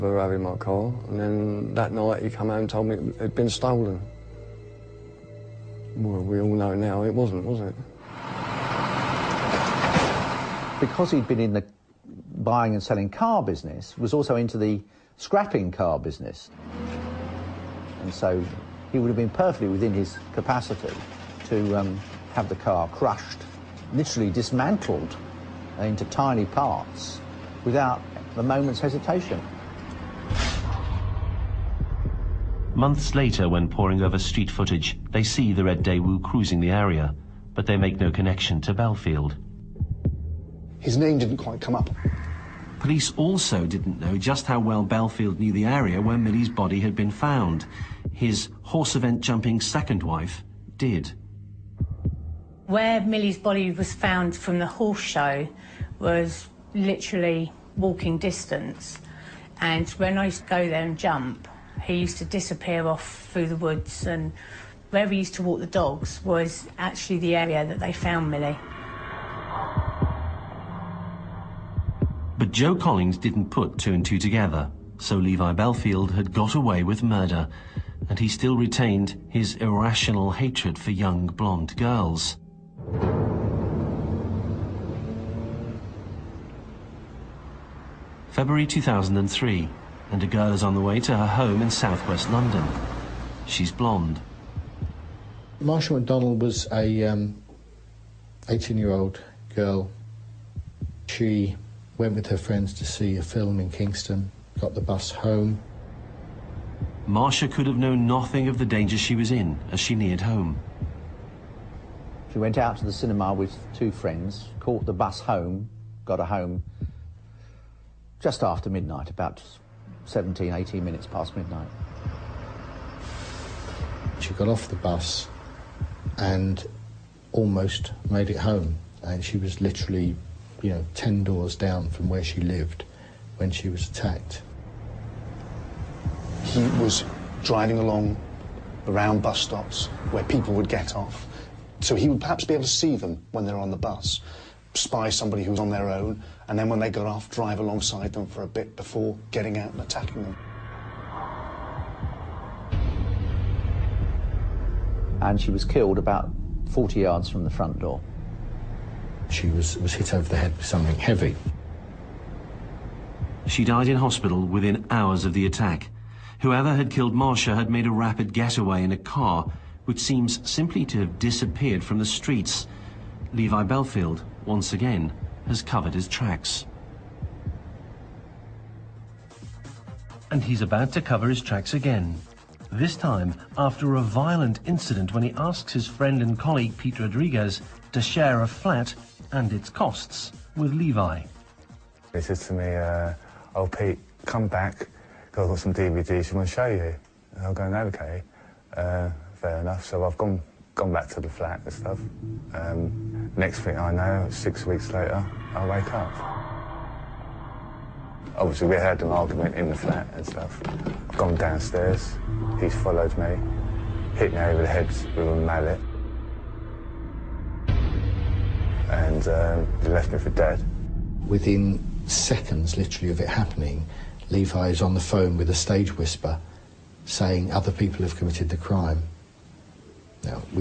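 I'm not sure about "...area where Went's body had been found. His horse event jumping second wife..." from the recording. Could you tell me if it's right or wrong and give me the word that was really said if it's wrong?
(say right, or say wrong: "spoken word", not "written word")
wrong: "Milly", not "Went".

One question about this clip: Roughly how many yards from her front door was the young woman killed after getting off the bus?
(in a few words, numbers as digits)
40 yards.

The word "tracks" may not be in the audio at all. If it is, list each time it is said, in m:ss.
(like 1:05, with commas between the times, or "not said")
2:56, 3:01.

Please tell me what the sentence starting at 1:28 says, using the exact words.
February 2003, and a girl is on the way to her home in southwest London.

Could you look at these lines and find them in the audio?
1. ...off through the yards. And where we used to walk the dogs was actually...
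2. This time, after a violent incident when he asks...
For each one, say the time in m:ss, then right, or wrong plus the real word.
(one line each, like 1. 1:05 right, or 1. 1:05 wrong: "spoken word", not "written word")
1. 1:02 wrong: "woods", not "yards"
2. 3:02 right.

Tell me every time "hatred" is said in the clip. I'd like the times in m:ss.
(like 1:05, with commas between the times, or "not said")
1:20.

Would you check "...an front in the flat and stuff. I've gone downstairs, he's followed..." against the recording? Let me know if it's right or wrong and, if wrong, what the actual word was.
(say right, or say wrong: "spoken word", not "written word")
wrong: "argument", not "front".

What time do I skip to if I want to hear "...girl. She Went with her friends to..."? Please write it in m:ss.
1:39.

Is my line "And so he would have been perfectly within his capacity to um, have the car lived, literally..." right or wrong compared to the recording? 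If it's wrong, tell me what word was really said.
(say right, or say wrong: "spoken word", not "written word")
wrong: "crushed", not "lived".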